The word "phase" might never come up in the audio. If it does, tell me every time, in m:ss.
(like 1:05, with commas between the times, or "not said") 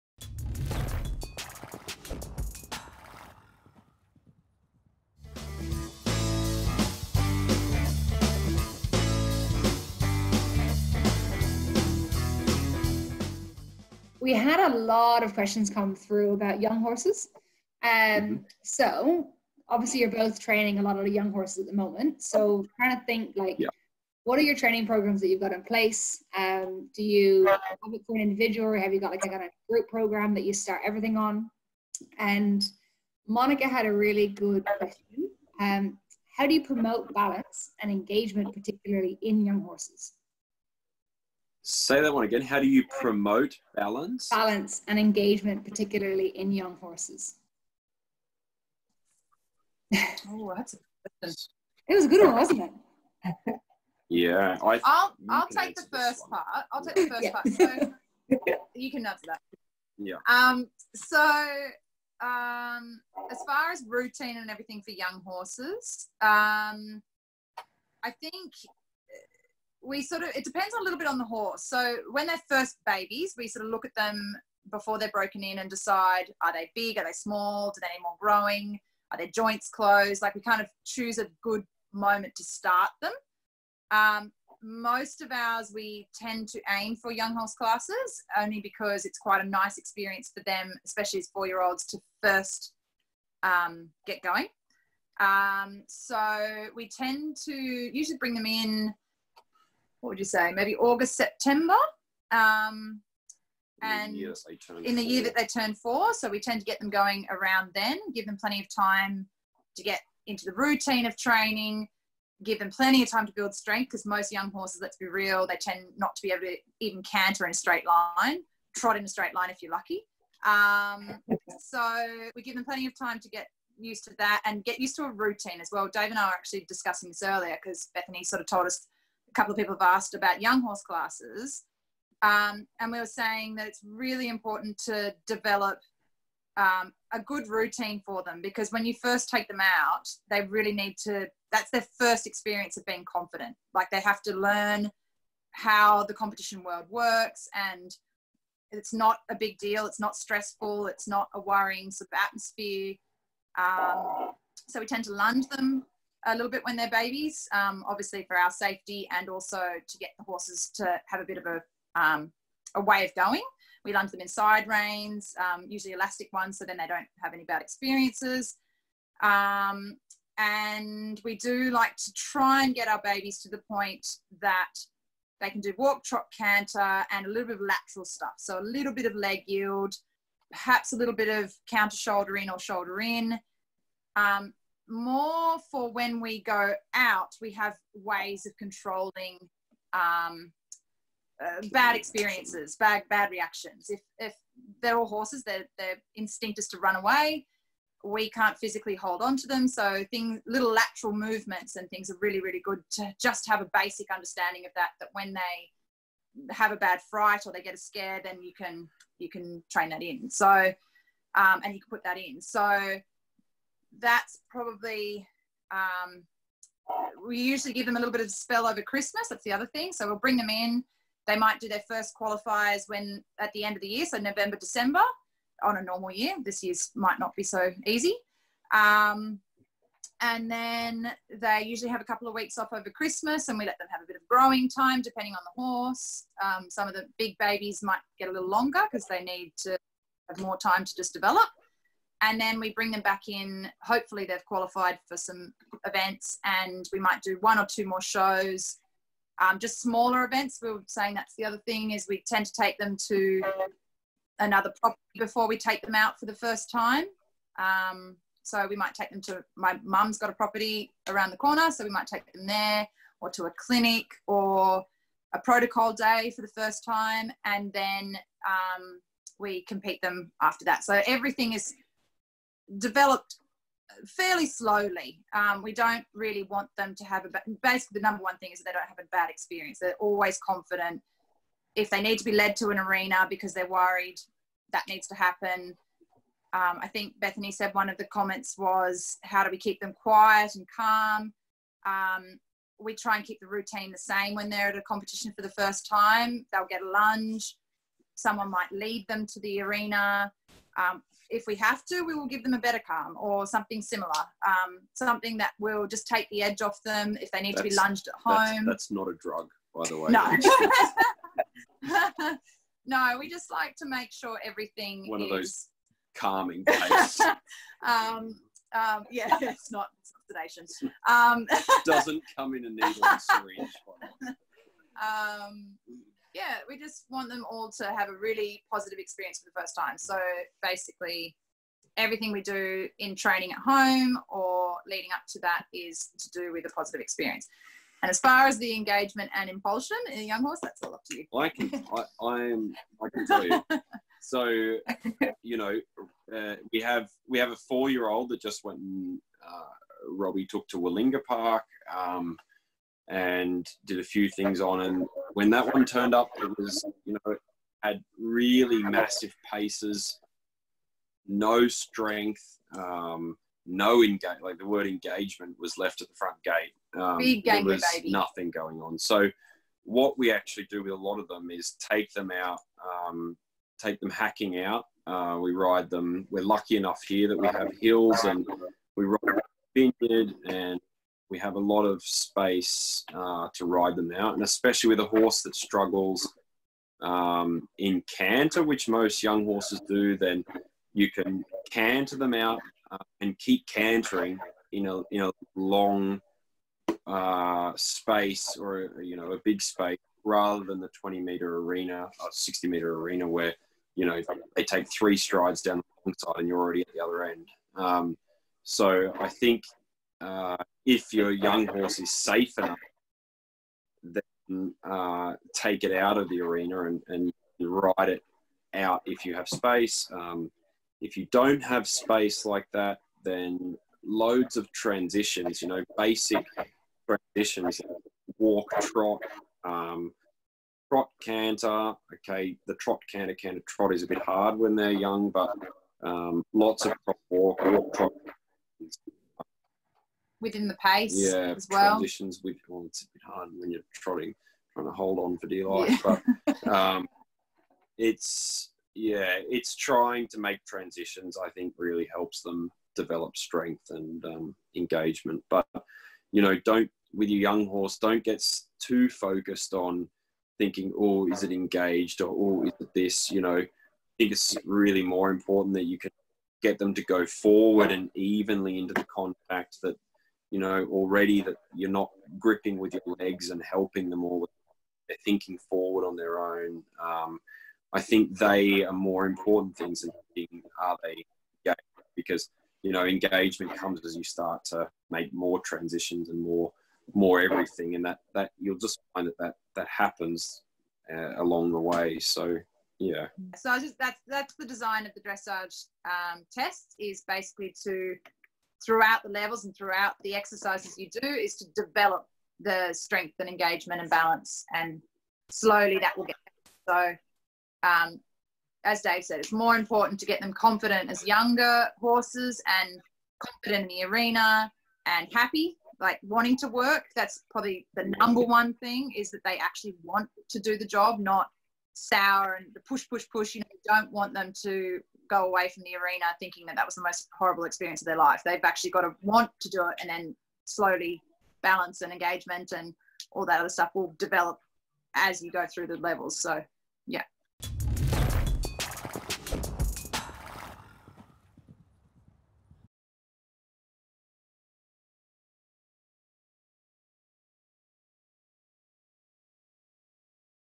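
not said.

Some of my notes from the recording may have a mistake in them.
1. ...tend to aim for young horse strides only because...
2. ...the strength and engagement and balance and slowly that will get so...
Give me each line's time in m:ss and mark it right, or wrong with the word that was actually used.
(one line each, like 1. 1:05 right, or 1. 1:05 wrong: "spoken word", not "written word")
1. 1:26 wrong: "classes", not "strides"
2. 8:22 right.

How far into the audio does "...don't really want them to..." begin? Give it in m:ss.
4:35.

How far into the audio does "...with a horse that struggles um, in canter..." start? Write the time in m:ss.
6:24.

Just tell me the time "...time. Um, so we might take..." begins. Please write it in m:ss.
4:16.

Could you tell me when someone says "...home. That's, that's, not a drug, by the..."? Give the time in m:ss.
5:08.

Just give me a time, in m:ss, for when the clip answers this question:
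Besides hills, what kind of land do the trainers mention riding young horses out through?
6:19.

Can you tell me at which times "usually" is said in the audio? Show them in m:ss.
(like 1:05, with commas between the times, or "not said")
1:37, 2:45, 3:37, 3:51.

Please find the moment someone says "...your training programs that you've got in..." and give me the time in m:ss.
0:24.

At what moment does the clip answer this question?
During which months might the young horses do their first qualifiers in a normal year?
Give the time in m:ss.
3:44.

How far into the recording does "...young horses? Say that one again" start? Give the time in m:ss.
0:39.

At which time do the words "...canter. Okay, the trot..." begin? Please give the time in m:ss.
7:11.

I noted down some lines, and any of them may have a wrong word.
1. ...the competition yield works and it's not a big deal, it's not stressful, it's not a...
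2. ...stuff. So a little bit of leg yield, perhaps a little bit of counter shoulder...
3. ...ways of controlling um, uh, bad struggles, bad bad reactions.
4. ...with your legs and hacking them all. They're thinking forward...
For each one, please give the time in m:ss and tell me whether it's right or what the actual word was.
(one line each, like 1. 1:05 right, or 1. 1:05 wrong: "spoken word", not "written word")
1. 2:26 wrong: "world", not "yield"
2. 2:58 right
3. 3:07 wrong: "experiences", not "struggles"
4. 7:52 wrong: "helping", not "hacking".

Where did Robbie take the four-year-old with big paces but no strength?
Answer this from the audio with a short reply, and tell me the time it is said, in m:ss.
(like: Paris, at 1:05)
Willinga Park, at 5:50.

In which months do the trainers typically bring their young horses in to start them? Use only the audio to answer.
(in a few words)
August, September.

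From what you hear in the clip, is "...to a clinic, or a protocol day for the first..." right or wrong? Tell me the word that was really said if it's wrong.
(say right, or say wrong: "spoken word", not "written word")
right.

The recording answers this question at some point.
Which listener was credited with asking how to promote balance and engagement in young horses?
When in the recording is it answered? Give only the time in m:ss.
0:33.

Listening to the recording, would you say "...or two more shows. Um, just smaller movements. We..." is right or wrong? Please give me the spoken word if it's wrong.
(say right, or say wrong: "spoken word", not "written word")
wrong: "events", not "movements".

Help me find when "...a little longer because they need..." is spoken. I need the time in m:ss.
3:58.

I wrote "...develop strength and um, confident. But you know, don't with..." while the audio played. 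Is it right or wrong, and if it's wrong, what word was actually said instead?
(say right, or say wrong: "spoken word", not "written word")
wrong: "engagement", not "confident".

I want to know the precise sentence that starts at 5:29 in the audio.
So basically, everything we do in training at home or leading up to that is to do with a positive experience.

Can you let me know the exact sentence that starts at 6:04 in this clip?
Like the word engagement was left at the front gate.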